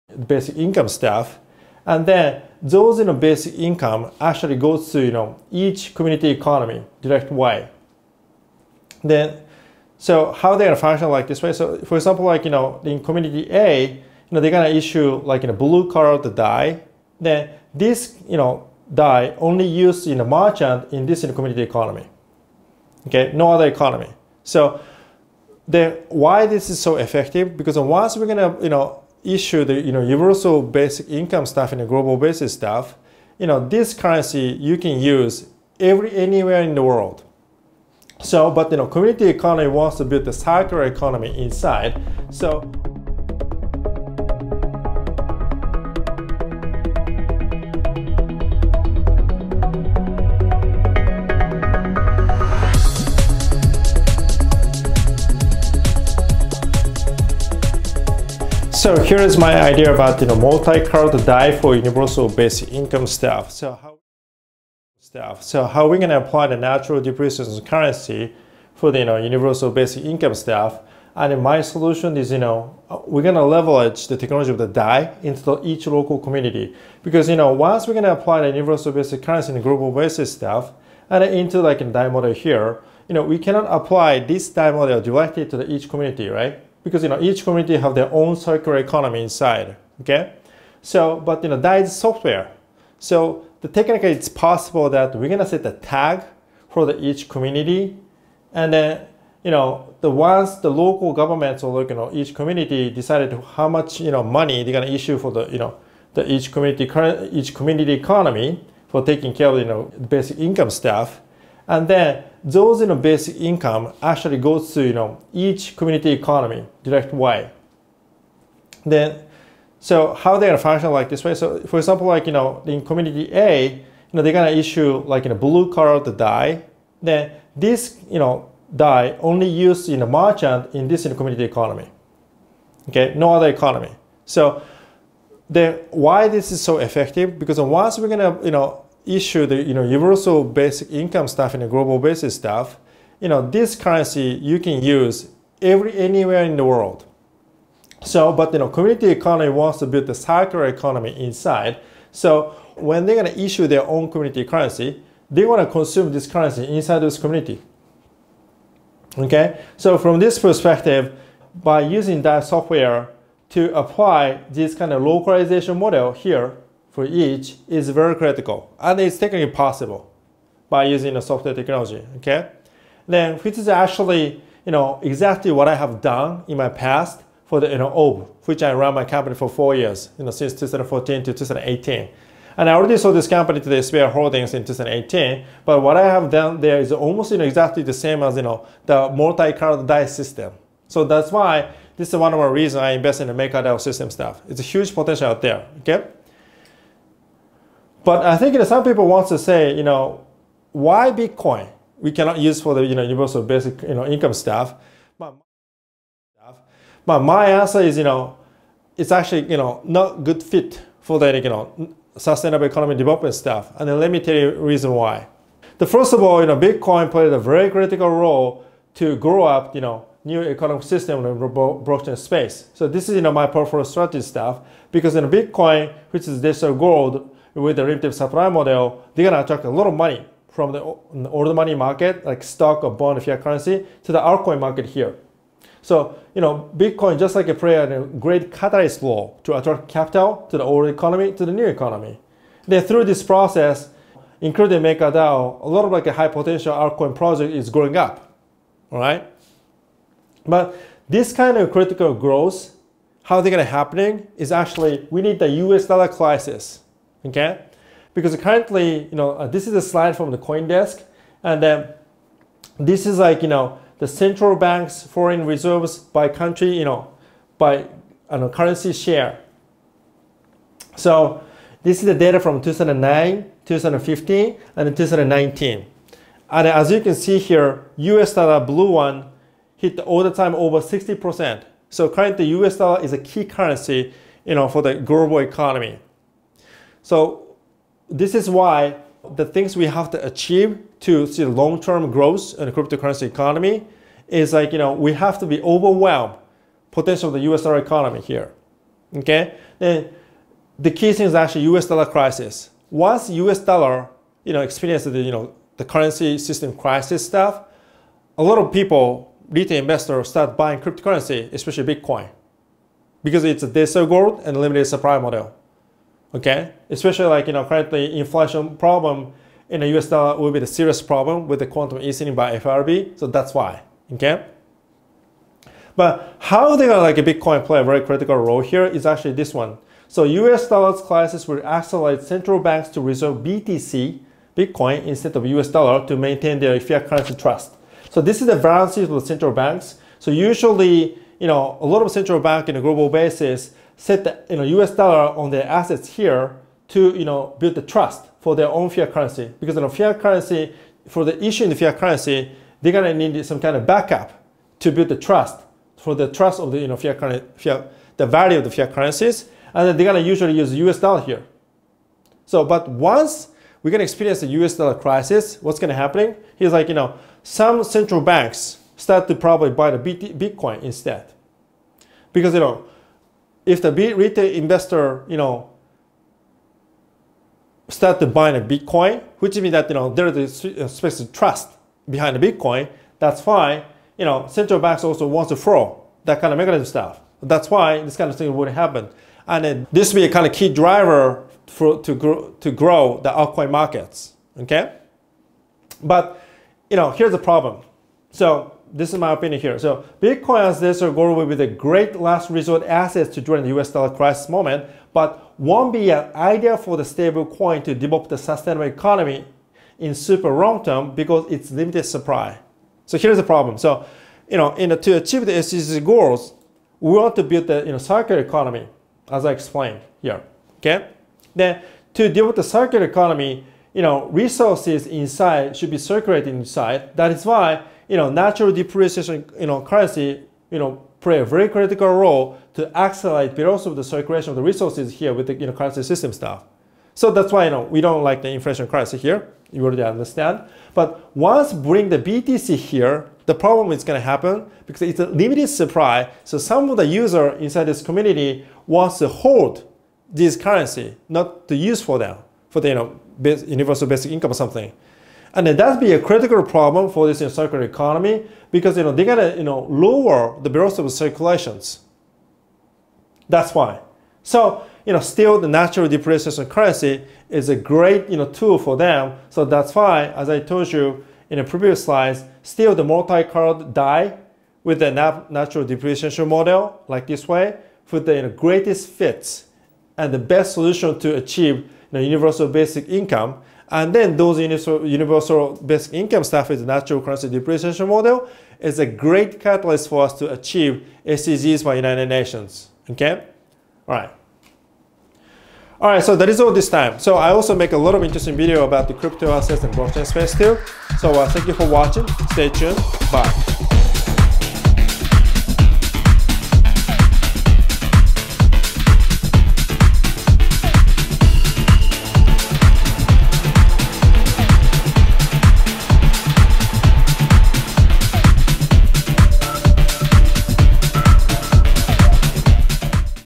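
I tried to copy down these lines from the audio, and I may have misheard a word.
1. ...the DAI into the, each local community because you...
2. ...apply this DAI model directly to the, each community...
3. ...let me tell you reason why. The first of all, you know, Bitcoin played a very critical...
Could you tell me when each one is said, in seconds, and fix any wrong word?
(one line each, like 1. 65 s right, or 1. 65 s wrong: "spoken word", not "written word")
1. 74 s right
2. 83 s right
3. 213 s right.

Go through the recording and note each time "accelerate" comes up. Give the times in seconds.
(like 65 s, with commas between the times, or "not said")
331 s, 432 s.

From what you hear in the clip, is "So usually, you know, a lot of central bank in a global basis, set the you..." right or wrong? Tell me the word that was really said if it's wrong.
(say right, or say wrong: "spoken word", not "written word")
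right.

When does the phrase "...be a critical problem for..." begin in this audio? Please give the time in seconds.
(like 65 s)
455 s.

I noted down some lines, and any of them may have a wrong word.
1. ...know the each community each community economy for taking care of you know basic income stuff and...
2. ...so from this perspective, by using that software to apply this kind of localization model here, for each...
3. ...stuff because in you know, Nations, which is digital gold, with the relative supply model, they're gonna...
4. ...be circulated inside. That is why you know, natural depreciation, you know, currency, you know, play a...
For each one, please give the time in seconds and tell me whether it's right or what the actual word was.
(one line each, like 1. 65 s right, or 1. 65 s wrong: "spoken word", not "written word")
1. 105 s right
2. 159 s right
3. 224 s wrong: "Bitcoin", not "Nations"
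4. 425 s right.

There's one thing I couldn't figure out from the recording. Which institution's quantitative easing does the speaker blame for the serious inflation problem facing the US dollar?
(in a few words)
FRB.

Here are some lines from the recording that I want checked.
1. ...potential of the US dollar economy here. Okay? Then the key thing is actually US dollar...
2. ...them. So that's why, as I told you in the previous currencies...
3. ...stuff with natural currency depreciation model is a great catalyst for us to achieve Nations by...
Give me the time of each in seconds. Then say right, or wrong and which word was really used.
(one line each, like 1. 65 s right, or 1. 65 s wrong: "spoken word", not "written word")
1. 296 s right
2. 468 s wrong: "slides", not "currencies"
3. 486 s wrong: "SDGs", not "Nations".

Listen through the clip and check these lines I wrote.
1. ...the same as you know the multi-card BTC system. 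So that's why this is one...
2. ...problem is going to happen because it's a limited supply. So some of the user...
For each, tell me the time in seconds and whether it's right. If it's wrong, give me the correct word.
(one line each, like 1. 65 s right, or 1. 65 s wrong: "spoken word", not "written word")
1. 187 s wrong: "DAI", not "BTC"
2. 443 s right.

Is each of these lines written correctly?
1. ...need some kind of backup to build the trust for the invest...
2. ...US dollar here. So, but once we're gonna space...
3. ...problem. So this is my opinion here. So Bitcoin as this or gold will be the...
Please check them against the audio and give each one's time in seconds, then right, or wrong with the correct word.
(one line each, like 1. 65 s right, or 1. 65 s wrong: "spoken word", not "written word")
1. 353 s wrong: "trust", not "invest"
2. 360 s wrong: "experience", not "space"
3. 397 s right.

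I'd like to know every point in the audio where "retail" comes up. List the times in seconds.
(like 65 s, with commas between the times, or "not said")
309 s, 373 s.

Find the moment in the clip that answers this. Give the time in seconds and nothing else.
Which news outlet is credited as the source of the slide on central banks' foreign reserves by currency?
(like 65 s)
260 s.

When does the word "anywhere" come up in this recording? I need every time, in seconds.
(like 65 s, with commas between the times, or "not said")
36 s, 145 s.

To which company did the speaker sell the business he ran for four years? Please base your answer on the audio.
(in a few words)
Sphere Holdings.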